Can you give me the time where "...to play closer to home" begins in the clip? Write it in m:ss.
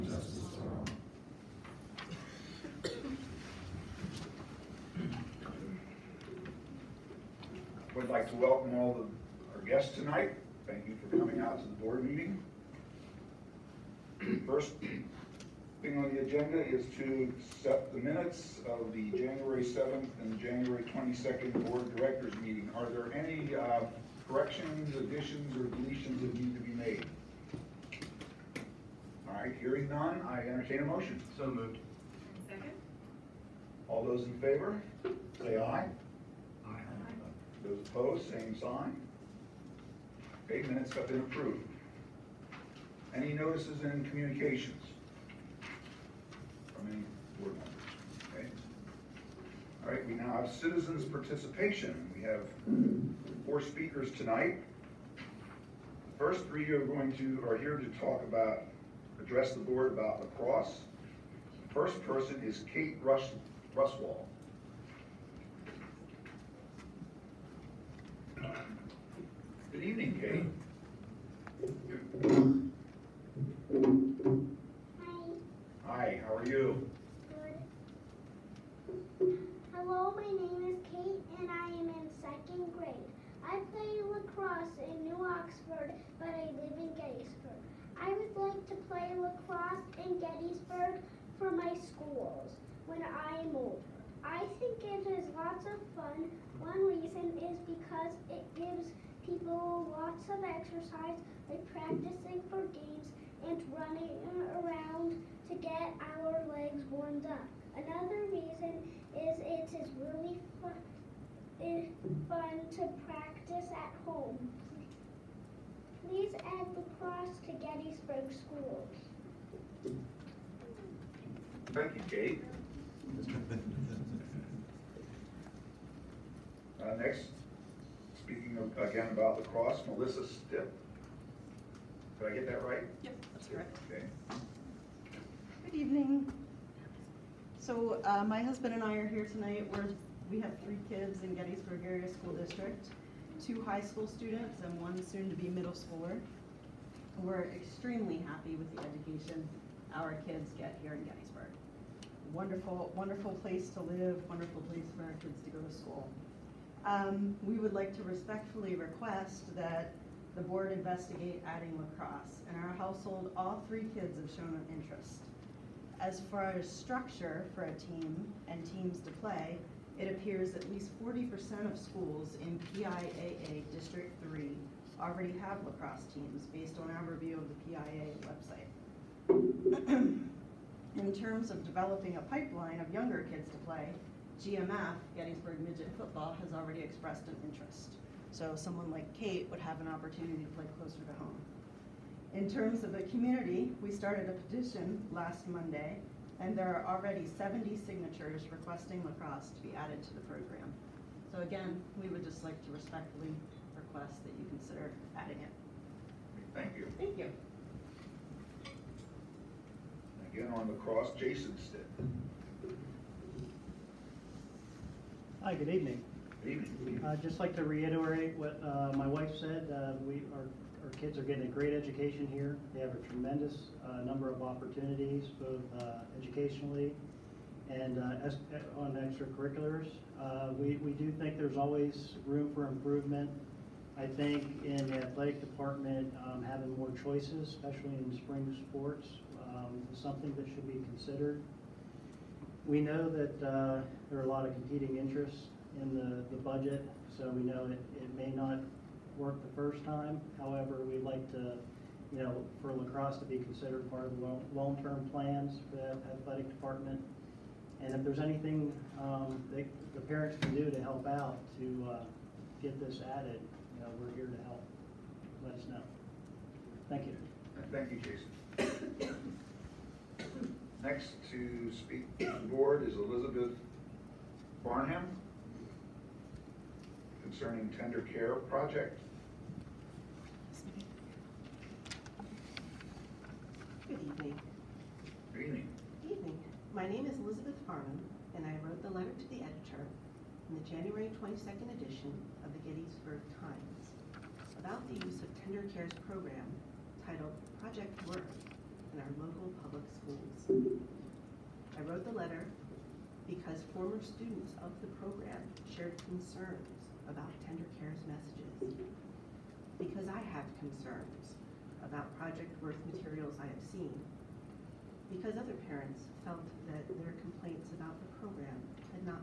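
3:10.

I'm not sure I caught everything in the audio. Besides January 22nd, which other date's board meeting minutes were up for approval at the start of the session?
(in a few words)
January 7th.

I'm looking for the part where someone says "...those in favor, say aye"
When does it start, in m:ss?
0:34.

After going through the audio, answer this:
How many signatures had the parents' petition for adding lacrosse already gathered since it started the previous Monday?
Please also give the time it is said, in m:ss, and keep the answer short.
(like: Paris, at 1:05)
70, at 3:17.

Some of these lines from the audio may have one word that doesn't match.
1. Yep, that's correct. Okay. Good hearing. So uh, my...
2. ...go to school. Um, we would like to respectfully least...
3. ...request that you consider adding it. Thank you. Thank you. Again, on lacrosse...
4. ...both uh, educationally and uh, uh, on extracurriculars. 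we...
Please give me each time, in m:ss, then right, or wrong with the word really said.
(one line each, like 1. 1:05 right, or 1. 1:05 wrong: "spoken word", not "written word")
1. 2:13 wrong: "evening", not "hearing"
2. 2:35 wrong: "request", not "least"
3. 3:23 right
4. 3:45 right.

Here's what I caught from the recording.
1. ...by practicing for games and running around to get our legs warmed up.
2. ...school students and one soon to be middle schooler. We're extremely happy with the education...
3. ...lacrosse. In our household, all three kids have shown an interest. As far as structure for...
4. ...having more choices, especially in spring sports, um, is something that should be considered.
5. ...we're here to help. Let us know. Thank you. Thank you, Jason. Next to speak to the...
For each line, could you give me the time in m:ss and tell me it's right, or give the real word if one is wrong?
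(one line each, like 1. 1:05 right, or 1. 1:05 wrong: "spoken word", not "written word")
1. 1:41 right
2. 2:23 right
3. 2:41 right
4. 3:56 right
5. 4:23 right.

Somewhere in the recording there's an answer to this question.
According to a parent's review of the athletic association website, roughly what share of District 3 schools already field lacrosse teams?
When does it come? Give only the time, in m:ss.
2:51.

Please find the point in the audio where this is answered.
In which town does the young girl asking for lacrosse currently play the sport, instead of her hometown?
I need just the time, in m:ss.
1:25.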